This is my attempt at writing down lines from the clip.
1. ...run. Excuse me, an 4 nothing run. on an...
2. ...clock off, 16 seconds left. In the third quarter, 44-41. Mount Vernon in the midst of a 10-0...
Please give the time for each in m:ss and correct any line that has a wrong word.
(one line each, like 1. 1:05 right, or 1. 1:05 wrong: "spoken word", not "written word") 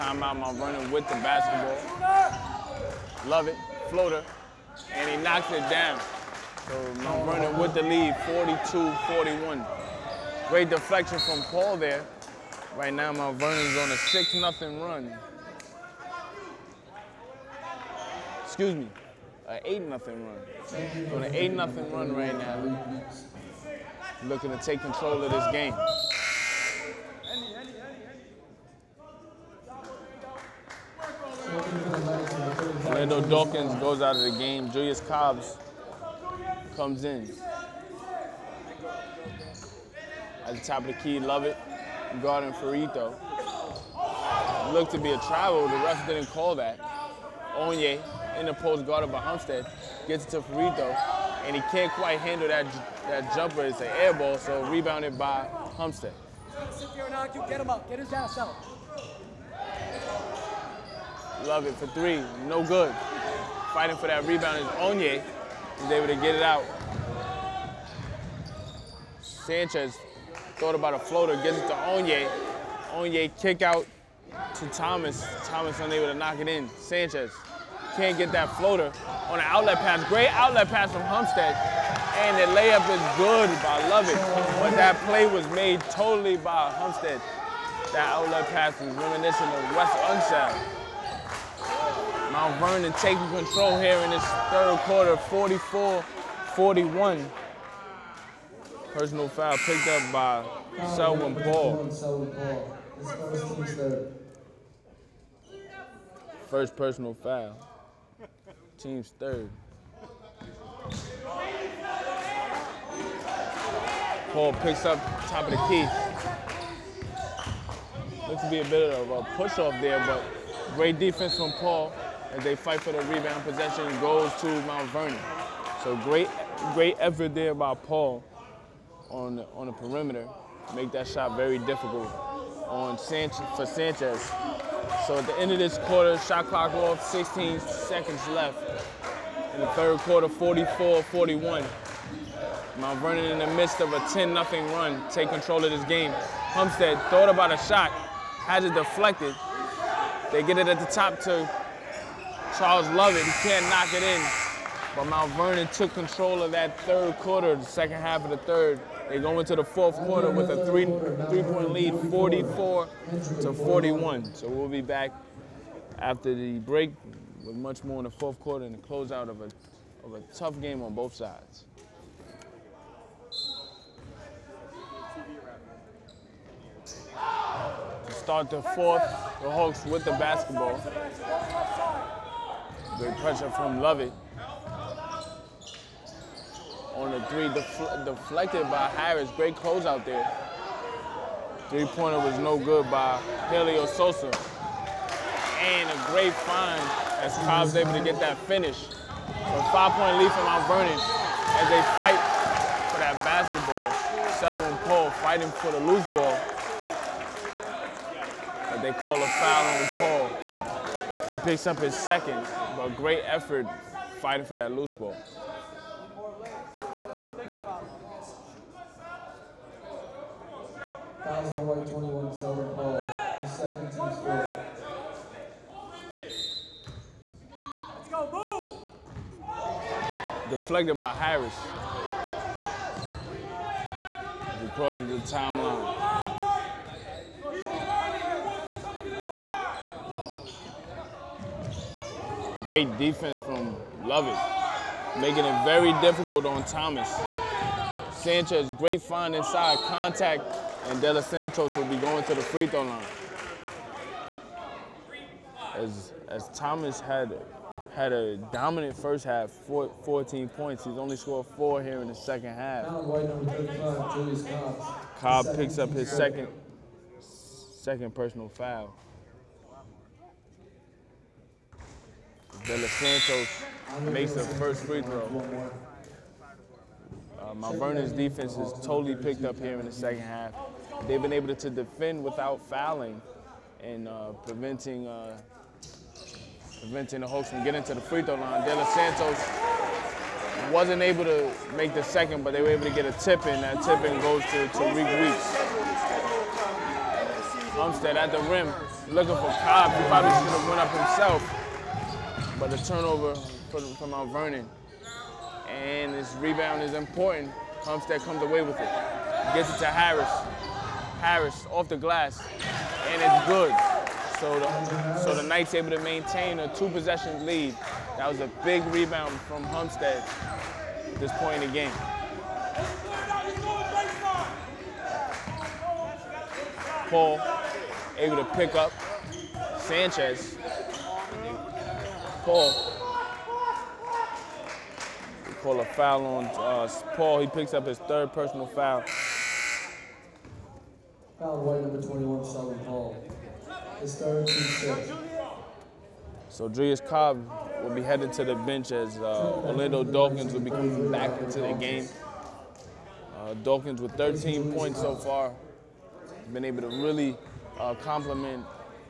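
1. 0:14 wrong: "8", not "4"
2. 2:16 right.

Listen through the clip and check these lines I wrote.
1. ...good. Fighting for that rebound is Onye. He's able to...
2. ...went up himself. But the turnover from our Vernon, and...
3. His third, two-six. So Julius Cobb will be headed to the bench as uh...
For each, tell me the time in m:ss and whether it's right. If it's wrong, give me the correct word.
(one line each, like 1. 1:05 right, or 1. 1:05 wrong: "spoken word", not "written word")
1. 1:02 right
2. 5:00 right
3. 5:44 right.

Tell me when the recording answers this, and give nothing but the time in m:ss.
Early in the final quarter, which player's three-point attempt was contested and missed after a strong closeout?
3:13.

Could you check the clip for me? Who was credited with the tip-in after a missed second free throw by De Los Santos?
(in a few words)
Tariq Weeks.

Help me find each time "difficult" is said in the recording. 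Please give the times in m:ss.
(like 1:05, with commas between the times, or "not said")
2:11, 4:06.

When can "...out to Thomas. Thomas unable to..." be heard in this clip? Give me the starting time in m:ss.
1:13.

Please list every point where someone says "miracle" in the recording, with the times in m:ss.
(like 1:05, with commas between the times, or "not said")
not said.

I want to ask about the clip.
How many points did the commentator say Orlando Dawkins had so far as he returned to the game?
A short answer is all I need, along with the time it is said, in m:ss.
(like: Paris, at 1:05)
13, at 5:54.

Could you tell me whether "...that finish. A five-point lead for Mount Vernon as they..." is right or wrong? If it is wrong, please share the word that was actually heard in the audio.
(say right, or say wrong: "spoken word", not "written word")
right.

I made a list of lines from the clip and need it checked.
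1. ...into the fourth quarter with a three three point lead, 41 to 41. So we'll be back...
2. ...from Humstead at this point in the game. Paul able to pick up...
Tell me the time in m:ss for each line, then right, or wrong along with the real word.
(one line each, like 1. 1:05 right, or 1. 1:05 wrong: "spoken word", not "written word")
1. 2:39 wrong: "44", not "41"
2. 5:19 right.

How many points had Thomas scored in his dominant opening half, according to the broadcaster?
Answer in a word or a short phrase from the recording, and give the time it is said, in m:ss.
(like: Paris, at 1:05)
14, at 4:20.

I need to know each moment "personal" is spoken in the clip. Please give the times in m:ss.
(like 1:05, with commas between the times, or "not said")
1:38, 1:46, 4:28, 5:38.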